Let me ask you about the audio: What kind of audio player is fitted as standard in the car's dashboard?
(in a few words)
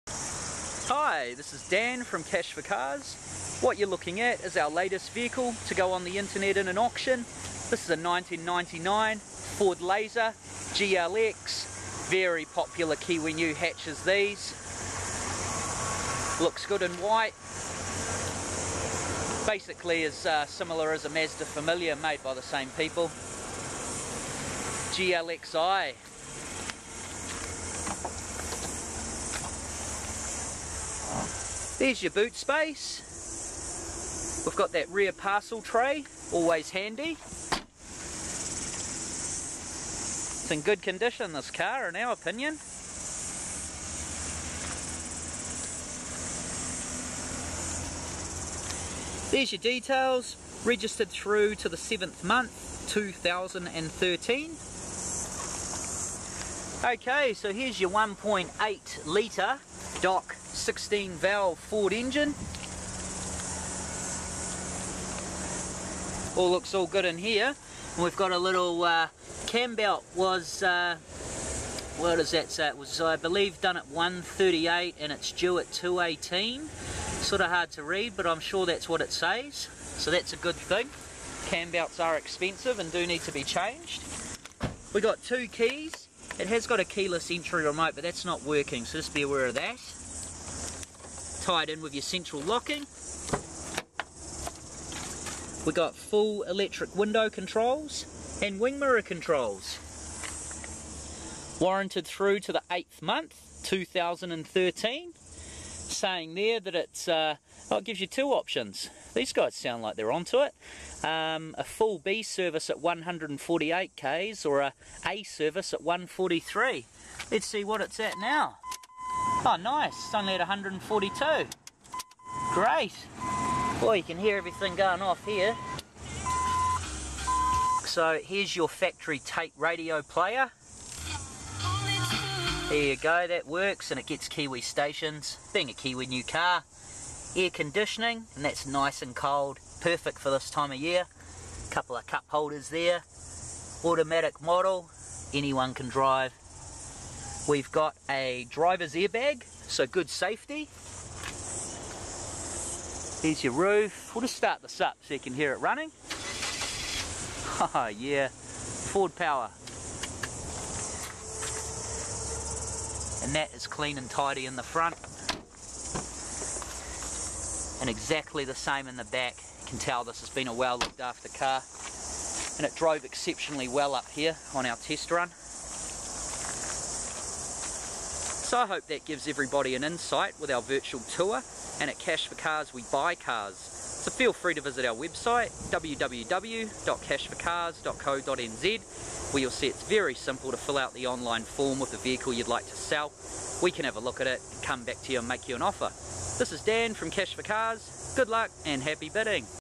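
tape radio player.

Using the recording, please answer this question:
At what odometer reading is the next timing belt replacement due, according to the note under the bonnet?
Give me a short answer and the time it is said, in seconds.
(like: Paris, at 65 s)
218, at 75 s.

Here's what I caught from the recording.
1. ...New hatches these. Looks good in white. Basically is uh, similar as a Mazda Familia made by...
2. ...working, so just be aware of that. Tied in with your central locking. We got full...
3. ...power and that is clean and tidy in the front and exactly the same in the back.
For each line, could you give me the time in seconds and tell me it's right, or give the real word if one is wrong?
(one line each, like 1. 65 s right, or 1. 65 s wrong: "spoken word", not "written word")
1. 13 s right
2. 88 s right
3. 159 s right.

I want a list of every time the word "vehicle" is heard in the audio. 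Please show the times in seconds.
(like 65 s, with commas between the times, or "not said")
5 s, 191 s.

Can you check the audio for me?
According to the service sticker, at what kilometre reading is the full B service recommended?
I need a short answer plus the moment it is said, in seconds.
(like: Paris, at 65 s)
148, at 112 s.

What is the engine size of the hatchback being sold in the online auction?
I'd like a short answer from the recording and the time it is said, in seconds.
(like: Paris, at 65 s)
1.8 litre, at 57 s.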